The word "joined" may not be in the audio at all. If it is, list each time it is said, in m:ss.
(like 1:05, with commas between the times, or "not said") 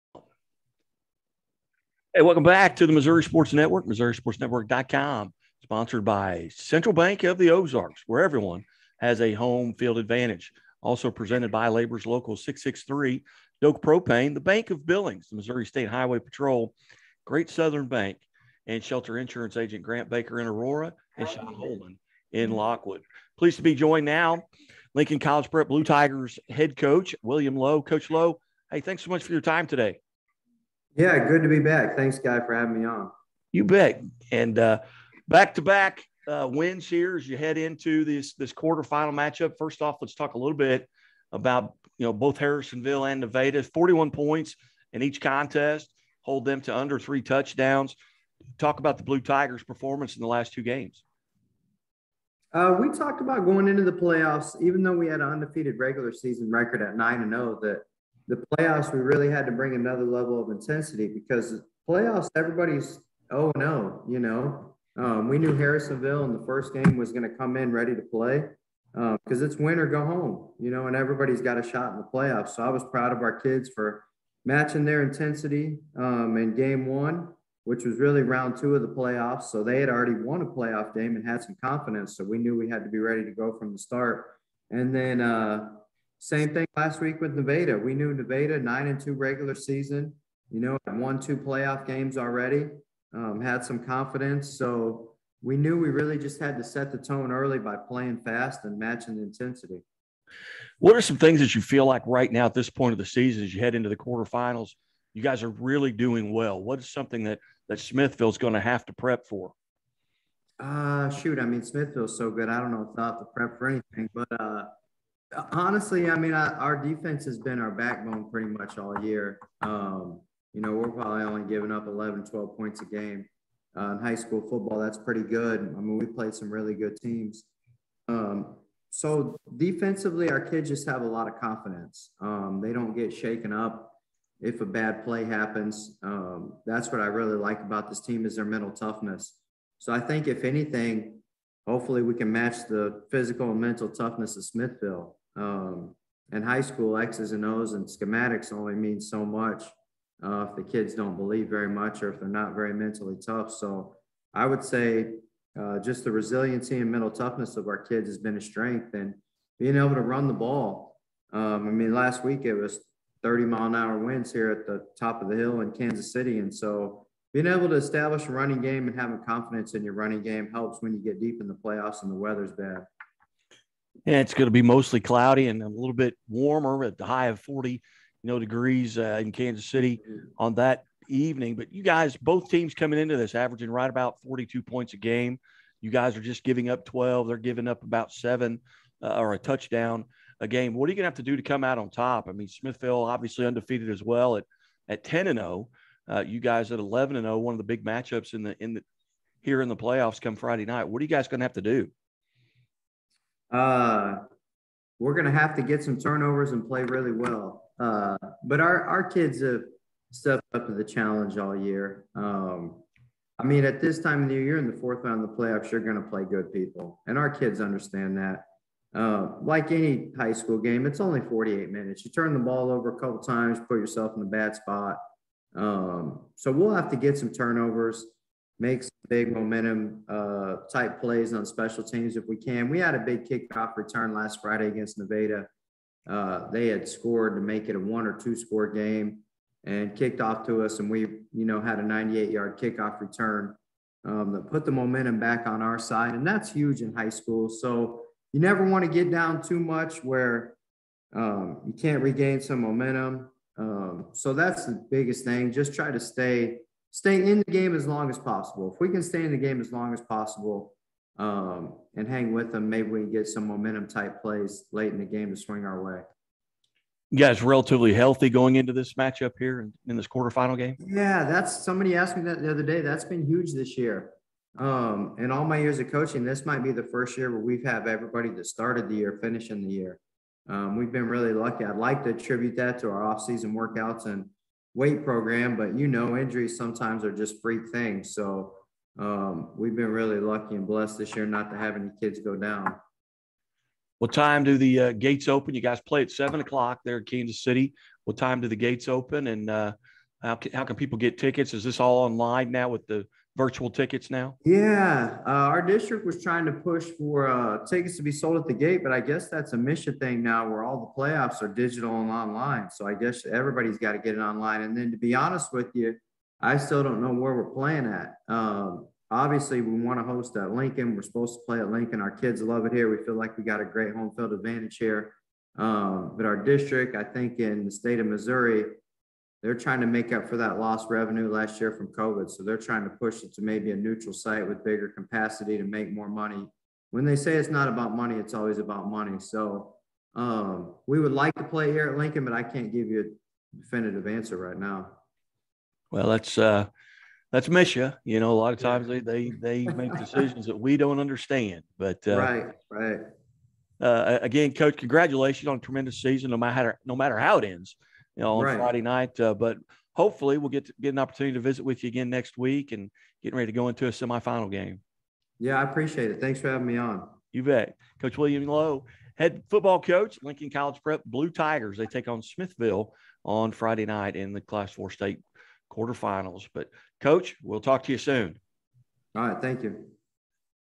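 0:23.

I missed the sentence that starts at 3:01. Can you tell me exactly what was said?
But you guys, both teams coming into this averaging right about 42 points a game.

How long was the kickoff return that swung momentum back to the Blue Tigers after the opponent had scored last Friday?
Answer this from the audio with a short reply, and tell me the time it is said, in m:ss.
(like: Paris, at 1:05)
98 yards, at 4:01.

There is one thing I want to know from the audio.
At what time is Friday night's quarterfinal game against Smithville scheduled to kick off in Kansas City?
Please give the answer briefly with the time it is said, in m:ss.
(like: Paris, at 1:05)
7:00, at 4:56.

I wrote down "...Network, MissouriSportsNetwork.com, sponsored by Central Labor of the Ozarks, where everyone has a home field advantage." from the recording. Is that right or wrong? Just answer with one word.
wrong.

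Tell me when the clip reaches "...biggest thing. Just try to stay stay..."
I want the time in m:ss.
4:14.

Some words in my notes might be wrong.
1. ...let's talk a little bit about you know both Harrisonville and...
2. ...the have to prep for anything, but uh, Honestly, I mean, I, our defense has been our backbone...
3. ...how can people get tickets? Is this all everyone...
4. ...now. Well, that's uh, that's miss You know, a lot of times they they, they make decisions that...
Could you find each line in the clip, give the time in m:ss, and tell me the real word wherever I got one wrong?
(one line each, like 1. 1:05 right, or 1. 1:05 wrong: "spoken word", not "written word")
1. 0:40 right
2. 1:53 right
3. 5:00 wrong: "online", not "everyone"
4. 5:44 right.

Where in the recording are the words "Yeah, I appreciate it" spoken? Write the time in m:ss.
6:05.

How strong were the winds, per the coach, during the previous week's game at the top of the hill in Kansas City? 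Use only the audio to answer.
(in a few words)
30 mph.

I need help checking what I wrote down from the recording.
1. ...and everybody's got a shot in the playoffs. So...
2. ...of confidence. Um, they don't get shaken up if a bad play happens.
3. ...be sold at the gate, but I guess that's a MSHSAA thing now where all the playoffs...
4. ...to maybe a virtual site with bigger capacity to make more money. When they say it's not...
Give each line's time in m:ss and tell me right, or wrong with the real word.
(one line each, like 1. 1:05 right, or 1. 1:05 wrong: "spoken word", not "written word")
1. 1:10 right
2. 2:11 right
3. 5:08 right
4. 5:33 wrong: "neutral", not "virtual".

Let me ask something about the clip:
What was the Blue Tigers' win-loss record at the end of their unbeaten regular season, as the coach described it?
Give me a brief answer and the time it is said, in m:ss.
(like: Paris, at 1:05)
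9-0, at 0:56.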